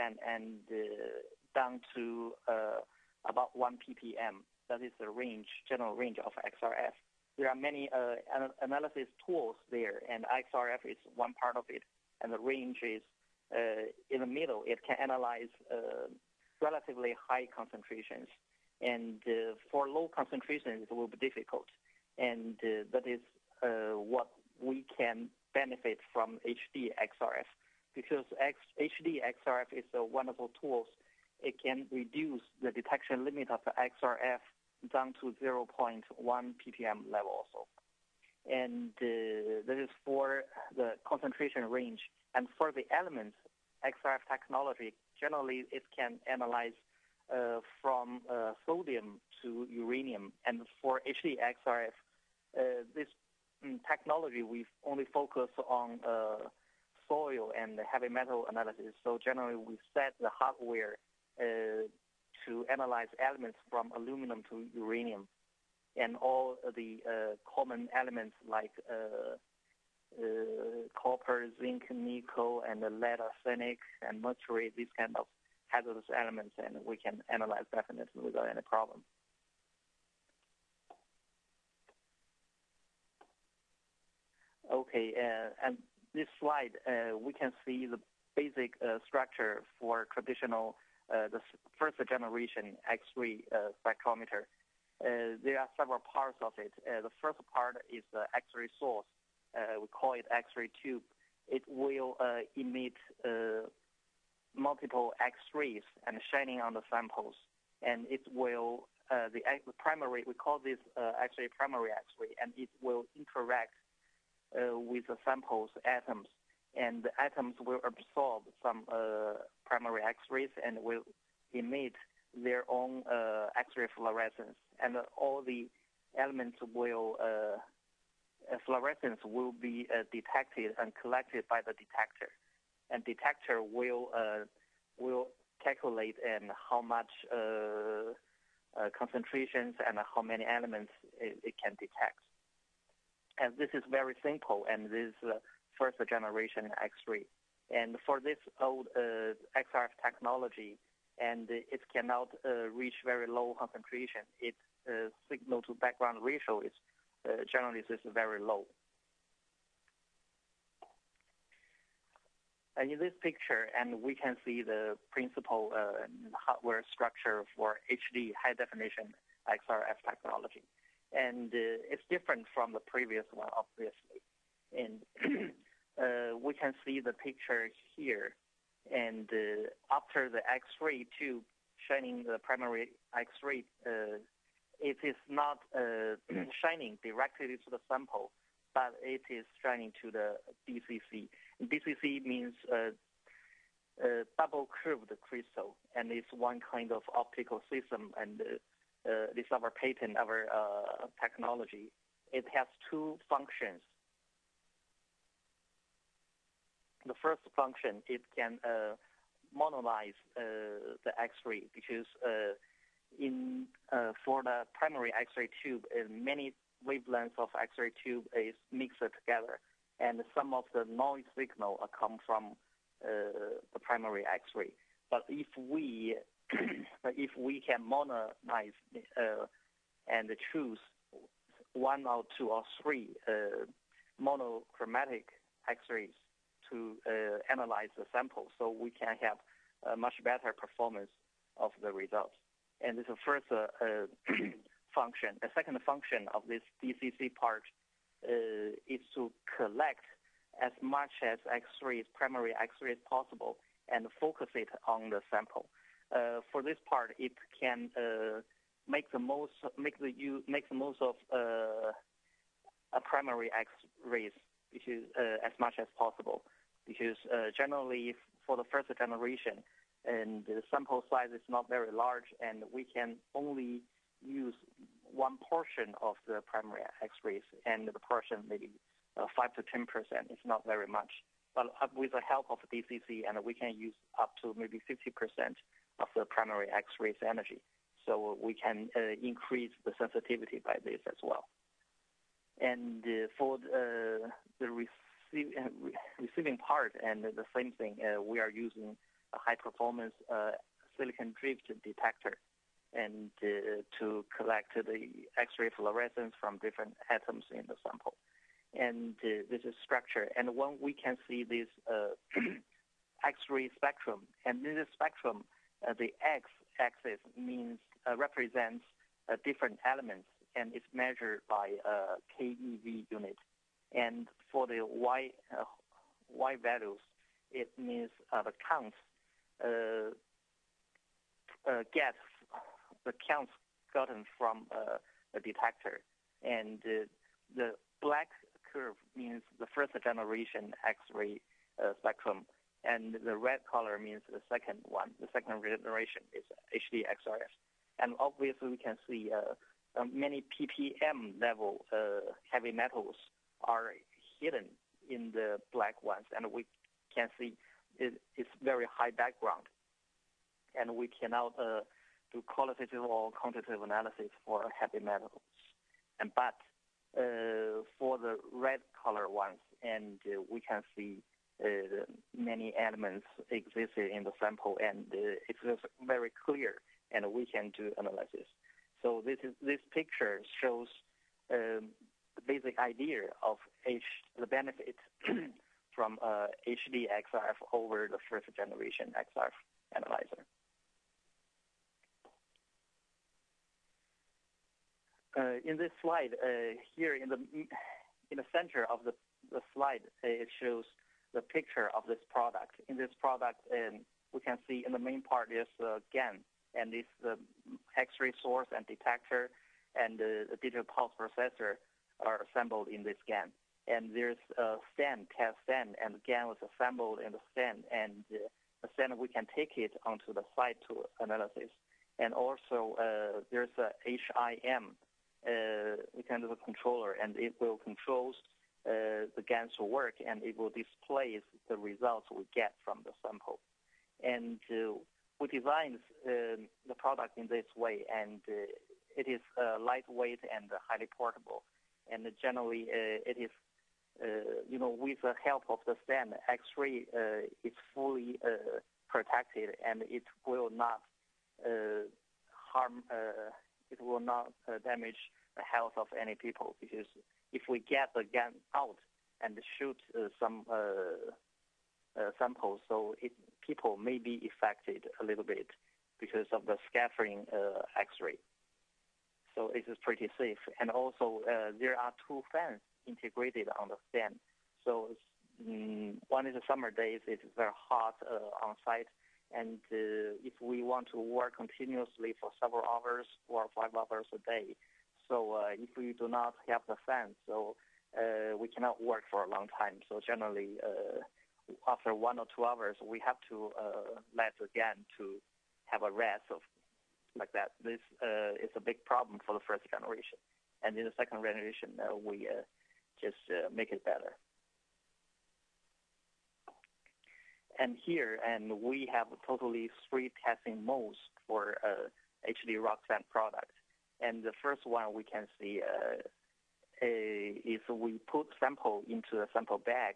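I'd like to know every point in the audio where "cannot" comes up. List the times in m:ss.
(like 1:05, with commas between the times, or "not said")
2:31, 6:01, 8:08.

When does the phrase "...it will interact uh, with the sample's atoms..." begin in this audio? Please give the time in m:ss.
1:52.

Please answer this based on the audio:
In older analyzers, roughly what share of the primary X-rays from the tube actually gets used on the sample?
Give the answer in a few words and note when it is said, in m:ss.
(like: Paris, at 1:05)
5 to 10 percent, at 4:39.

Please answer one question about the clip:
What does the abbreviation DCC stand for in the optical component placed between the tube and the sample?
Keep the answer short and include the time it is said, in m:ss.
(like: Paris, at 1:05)
double curved crystal, at 3:14.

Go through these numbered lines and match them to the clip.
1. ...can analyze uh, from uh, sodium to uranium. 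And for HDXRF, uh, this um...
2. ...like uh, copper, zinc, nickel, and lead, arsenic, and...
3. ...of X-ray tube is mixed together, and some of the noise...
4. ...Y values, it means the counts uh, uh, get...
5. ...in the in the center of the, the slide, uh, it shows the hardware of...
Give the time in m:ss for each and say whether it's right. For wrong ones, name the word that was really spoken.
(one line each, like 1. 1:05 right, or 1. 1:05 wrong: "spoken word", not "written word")
1. 0:45 right
2. 1:08 right
3. 3:37 right
4. 5:24 right
5. 6:37 wrong: "picture", not "hardware".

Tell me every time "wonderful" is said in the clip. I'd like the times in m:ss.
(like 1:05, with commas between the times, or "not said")
0:30.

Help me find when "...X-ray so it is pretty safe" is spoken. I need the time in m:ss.
7:47.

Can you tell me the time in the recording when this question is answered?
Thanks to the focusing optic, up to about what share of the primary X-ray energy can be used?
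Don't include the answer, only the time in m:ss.
4:44.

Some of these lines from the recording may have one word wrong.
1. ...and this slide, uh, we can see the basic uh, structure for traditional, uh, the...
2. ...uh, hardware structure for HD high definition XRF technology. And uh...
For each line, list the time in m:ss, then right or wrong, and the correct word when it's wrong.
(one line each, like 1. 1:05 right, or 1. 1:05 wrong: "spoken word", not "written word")
1. 1:25 right
2. 2:45 right.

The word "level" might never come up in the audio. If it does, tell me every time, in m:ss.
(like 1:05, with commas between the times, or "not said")
0:37, 5:51.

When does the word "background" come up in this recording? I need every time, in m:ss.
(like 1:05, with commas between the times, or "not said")
2:35, 5:59.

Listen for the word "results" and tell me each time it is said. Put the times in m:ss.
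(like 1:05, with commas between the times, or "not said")
4:01, 7:11.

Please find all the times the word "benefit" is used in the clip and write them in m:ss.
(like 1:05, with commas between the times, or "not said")
0:25, 6:24.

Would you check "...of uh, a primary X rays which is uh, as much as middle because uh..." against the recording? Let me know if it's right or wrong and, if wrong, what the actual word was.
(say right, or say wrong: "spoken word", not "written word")
wrong: "possible", not "middle".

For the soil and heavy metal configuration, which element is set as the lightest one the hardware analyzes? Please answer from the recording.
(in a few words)
aluminum.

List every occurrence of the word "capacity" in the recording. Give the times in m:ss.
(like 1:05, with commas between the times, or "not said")
not said.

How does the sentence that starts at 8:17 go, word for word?
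This uh, is a big problem for the first generation.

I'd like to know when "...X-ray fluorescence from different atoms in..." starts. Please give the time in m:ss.
5:05.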